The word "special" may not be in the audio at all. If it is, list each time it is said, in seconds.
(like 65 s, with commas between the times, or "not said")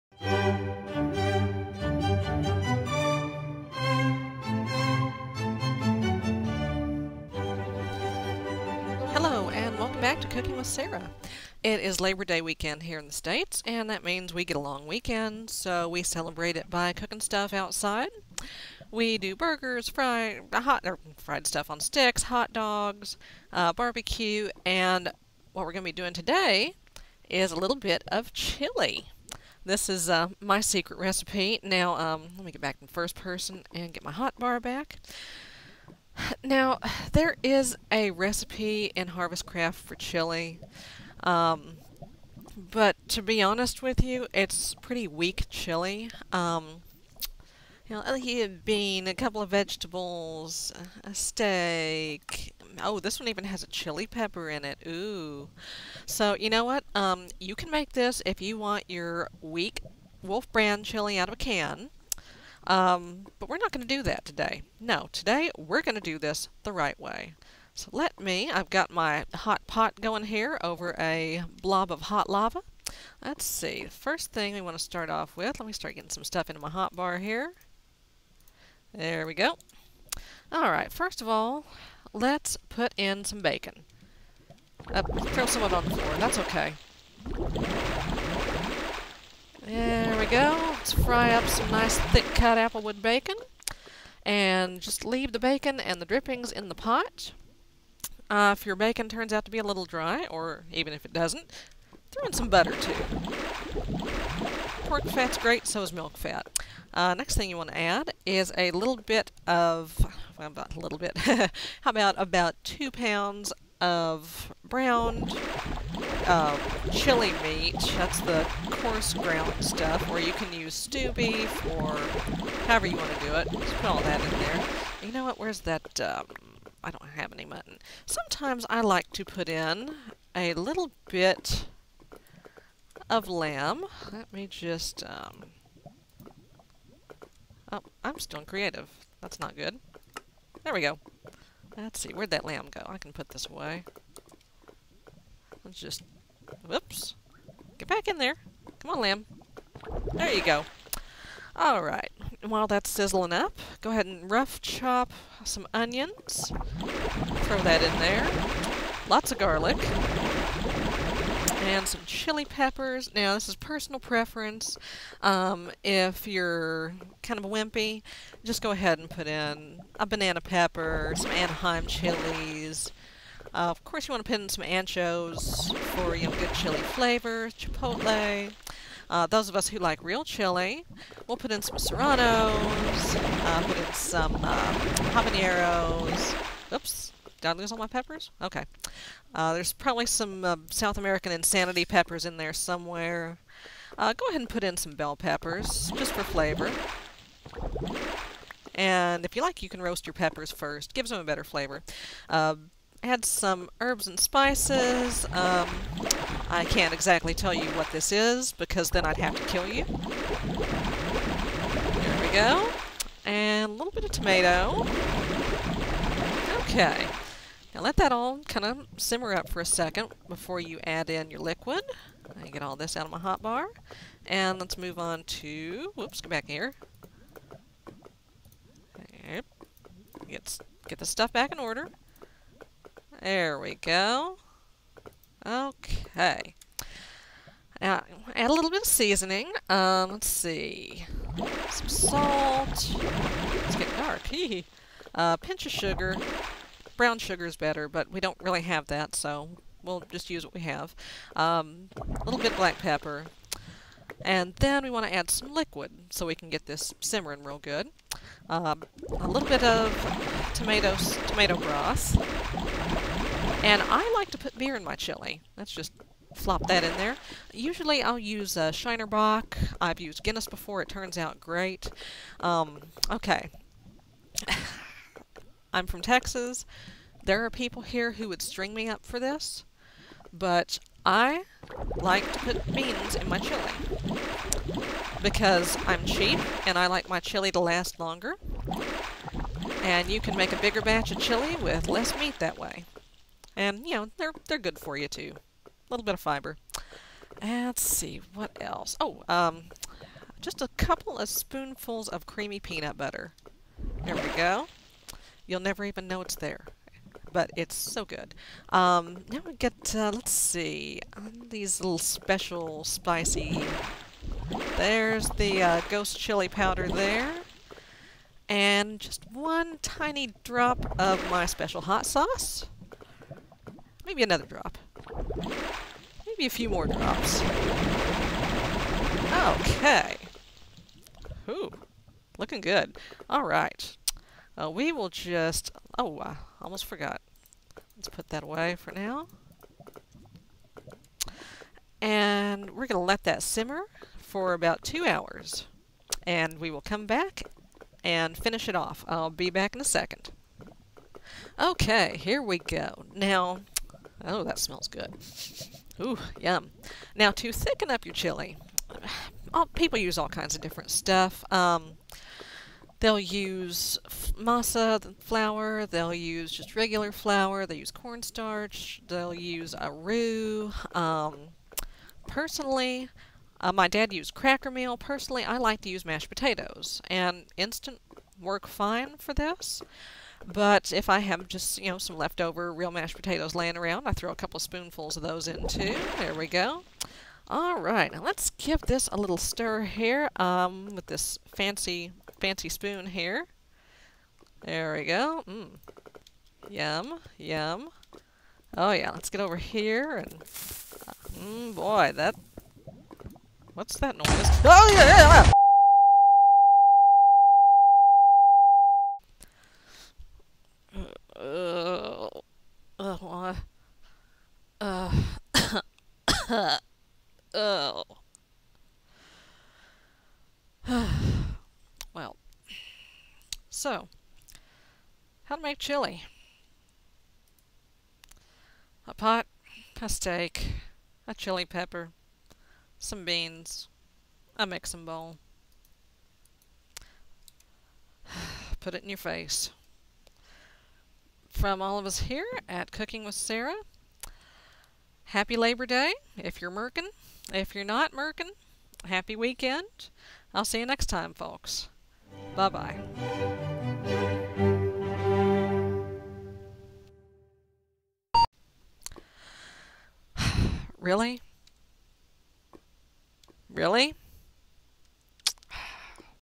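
311 s, 321 s.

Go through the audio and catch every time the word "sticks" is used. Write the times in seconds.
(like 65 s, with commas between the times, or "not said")
21 s.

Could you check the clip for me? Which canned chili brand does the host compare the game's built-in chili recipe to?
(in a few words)
Wolf brand.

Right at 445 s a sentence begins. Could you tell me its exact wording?
Happy Labor Day if you're merkin.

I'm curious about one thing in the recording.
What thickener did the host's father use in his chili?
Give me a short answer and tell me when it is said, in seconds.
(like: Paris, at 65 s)
cracker meal, at 374 s.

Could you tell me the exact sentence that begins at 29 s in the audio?
This is uh, my secret recipe.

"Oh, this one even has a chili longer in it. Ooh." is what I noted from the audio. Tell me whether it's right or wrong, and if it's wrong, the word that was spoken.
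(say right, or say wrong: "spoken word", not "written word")
wrong: "pepper", not "longer".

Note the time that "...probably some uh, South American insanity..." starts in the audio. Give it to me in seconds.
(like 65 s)
189 s.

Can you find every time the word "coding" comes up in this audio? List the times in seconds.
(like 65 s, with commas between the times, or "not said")
not said.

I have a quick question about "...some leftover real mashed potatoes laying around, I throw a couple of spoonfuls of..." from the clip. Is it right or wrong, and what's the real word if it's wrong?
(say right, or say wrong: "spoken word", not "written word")
right.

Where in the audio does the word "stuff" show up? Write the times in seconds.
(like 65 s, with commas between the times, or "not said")
17 s, 21 s, 76 s, 119 s, 231 s, 360 s.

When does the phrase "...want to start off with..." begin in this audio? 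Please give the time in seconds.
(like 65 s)
74 s.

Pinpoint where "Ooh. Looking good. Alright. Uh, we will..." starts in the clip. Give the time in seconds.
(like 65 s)
331 s.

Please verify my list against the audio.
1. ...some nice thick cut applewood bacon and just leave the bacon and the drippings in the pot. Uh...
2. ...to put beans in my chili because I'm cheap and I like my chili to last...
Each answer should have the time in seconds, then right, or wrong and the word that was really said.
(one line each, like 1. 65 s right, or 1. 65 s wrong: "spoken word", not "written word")
1. 91 s right
2. 282 s right.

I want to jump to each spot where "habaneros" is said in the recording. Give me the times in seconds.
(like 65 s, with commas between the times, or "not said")
185 s.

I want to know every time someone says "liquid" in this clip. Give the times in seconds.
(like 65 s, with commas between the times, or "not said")
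221 s, 255 s.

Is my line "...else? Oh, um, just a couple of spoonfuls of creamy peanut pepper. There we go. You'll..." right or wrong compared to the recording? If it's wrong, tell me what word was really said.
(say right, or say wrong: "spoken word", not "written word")
wrong: "butter", not "pepper".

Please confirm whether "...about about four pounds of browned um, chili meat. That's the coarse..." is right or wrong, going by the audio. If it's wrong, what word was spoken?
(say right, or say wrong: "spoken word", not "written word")
wrong: "two", not "four".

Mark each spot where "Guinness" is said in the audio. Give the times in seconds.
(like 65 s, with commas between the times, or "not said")
270 s.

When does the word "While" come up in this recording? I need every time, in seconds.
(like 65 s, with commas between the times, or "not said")
152 s.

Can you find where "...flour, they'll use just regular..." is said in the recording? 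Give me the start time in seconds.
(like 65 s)
365 s.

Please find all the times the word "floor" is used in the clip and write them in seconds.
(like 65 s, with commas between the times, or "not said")
85 s.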